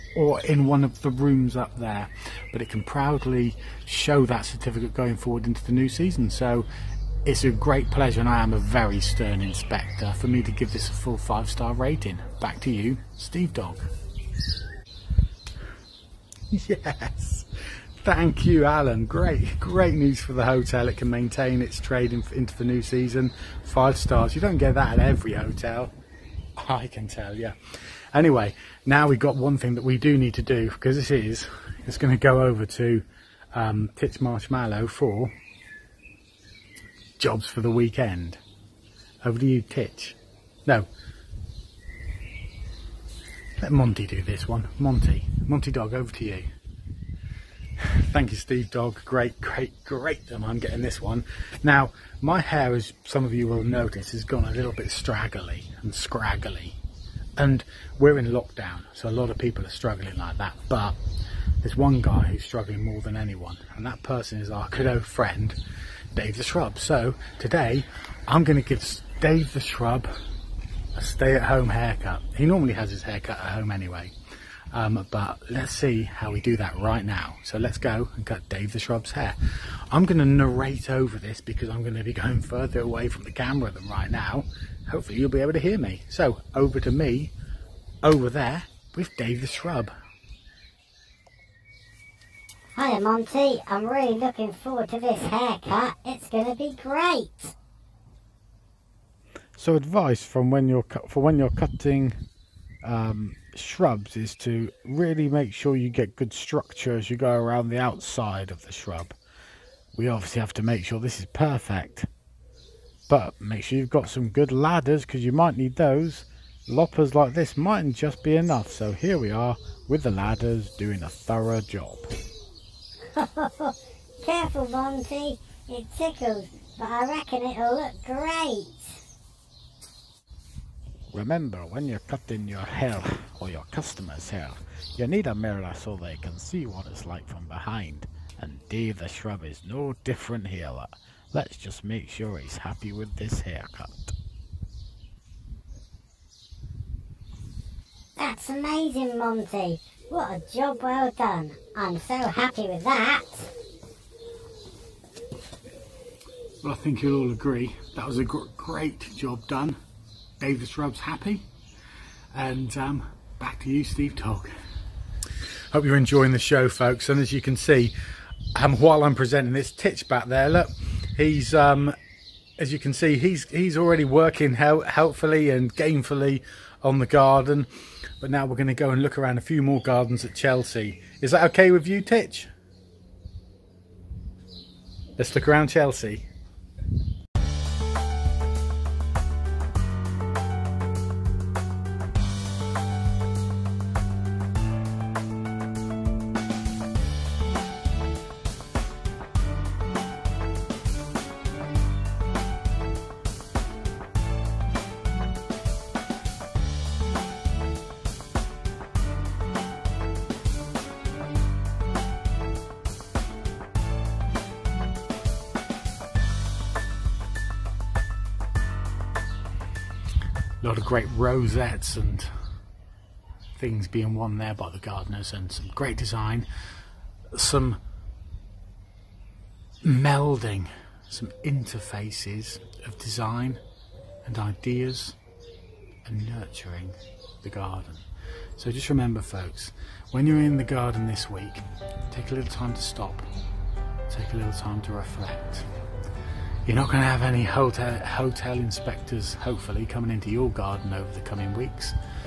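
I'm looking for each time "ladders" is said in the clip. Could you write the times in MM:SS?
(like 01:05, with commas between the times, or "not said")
01:54, 02:00.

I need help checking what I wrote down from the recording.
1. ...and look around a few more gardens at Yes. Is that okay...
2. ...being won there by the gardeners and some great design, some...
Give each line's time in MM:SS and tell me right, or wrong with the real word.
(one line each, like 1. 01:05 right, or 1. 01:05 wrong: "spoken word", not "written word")
1. 02:58 wrong: "Chelsea", not "Yes"
2. 03:43 right.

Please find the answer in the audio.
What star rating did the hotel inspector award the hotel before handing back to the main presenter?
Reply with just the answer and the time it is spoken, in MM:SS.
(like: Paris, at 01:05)
5 stars, at 00:11.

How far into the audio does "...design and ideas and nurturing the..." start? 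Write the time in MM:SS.
03:52.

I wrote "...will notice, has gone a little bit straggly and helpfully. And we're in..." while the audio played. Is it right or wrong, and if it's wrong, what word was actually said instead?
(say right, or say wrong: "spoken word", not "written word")
wrong: "scraggly", not "helpfully".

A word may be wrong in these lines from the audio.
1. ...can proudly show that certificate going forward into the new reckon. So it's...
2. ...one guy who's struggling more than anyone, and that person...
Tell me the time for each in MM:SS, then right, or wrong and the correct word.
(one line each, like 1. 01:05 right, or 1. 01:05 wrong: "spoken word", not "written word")
1. 00:02 wrong: "season", not "reckon"
2. 01:01 right.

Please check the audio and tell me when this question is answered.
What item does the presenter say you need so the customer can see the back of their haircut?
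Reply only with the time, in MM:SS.
02:15.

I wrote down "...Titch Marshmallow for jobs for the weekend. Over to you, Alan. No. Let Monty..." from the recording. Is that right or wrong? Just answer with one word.
wrong.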